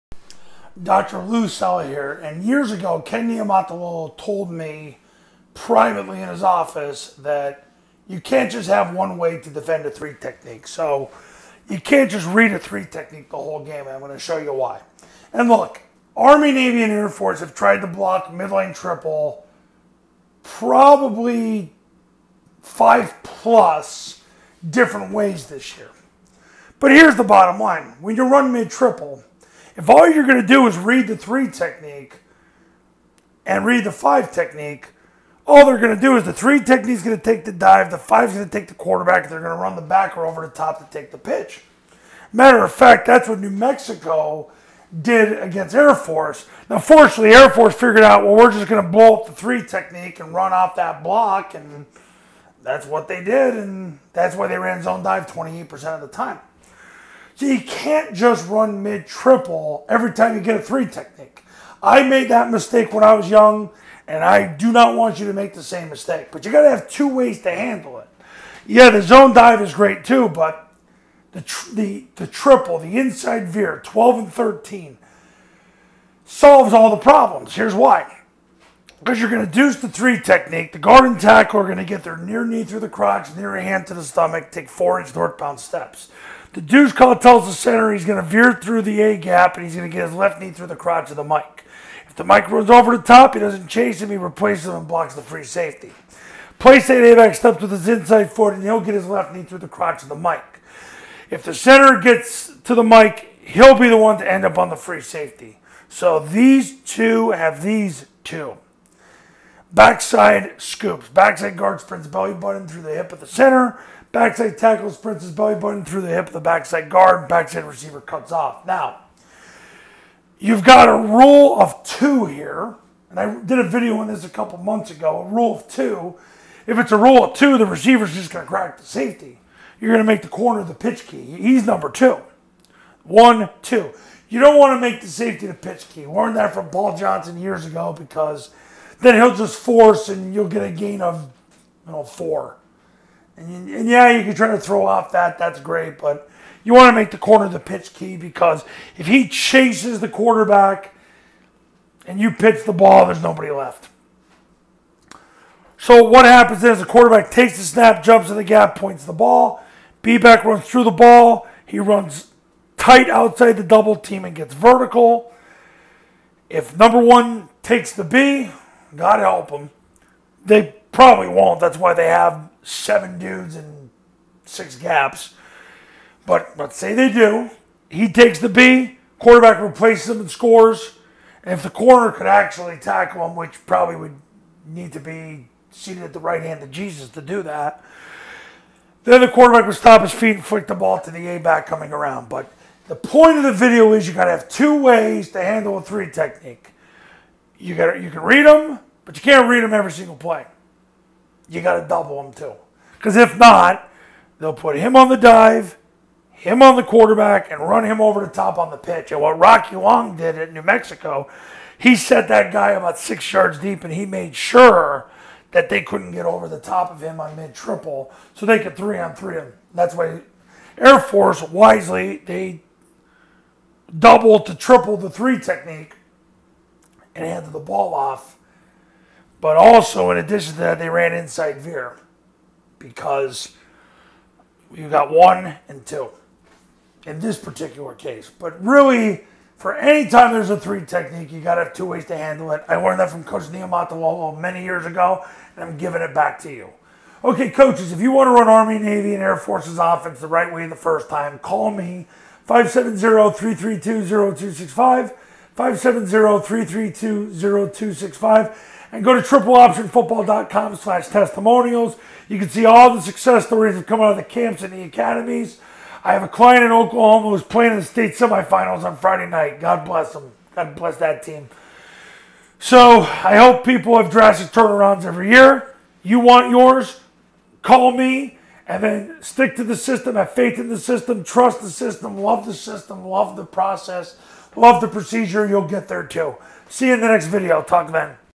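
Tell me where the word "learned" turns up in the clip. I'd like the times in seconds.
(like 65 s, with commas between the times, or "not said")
136 s, 242 s.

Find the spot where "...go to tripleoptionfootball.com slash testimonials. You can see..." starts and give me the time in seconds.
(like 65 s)
259 s.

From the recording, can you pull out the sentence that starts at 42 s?
Matter of fact, that's what New Mexico did against Air Force.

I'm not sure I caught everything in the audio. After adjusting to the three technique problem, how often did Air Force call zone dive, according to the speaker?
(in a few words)
28%.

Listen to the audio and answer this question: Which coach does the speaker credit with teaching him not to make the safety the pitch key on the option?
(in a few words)
Paul Johnson.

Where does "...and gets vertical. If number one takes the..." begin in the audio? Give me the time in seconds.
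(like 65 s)
164 s.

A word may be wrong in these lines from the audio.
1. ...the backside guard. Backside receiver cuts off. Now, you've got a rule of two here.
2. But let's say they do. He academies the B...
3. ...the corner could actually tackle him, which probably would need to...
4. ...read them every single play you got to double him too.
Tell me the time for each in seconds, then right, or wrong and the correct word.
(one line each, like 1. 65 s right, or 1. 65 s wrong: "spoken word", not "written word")
1. 116 s right
2. 176 s wrong: "takes", not "academies"
3. 181 s right
4. 199 s right.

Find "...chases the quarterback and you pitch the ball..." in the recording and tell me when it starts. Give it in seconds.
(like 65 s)
149 s.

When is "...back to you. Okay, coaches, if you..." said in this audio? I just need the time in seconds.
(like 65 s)
246 s.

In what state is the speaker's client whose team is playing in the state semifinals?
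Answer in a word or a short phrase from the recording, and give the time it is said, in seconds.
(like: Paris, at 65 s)
Oklahoma, at 266 s.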